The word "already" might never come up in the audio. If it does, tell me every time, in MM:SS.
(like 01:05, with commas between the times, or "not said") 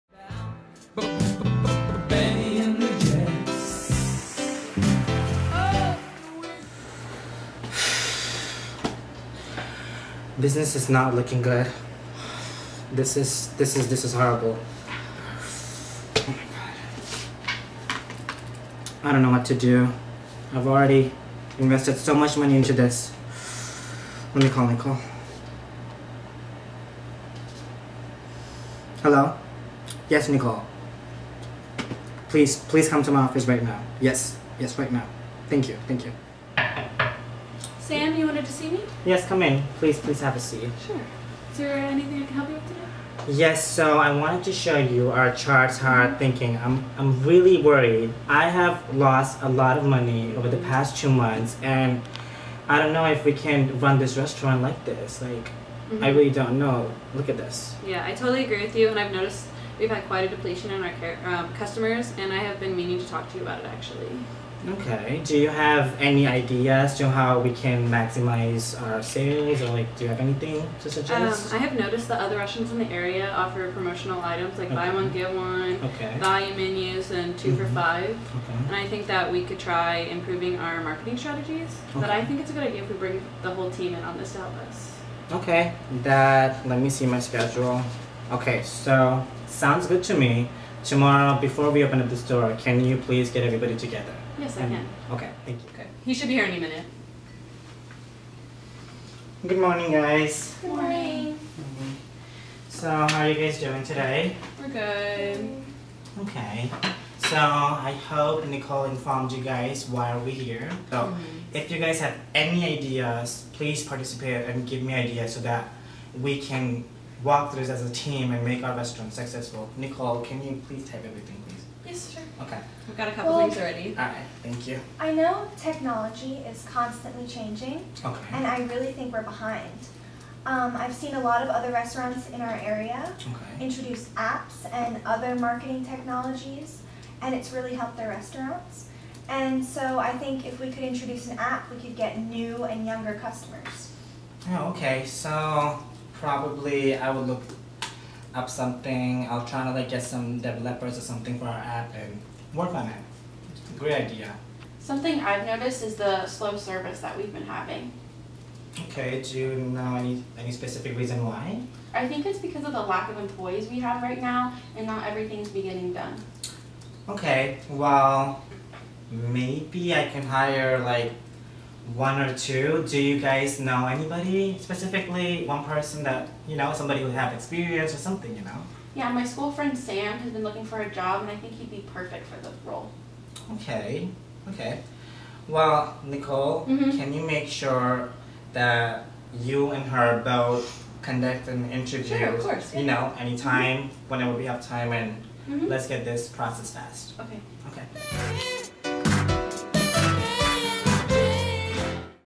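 00:20, 02:03.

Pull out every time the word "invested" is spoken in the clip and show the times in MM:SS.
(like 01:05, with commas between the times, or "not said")
00:21.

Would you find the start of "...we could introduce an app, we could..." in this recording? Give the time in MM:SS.
02:20.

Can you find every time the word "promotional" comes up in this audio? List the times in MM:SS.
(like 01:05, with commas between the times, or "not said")
01:13.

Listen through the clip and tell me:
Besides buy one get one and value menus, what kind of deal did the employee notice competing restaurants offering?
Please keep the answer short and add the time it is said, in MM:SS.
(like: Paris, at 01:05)
2 for 5, at 01:17.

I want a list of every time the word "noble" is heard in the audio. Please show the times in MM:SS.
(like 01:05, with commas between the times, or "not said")
not said.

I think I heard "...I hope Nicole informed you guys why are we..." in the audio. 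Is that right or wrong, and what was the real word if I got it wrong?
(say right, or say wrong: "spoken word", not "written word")
right.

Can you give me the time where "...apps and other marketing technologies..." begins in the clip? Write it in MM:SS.
02:14.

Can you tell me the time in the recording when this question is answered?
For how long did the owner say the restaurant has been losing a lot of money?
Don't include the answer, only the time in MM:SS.
00:50.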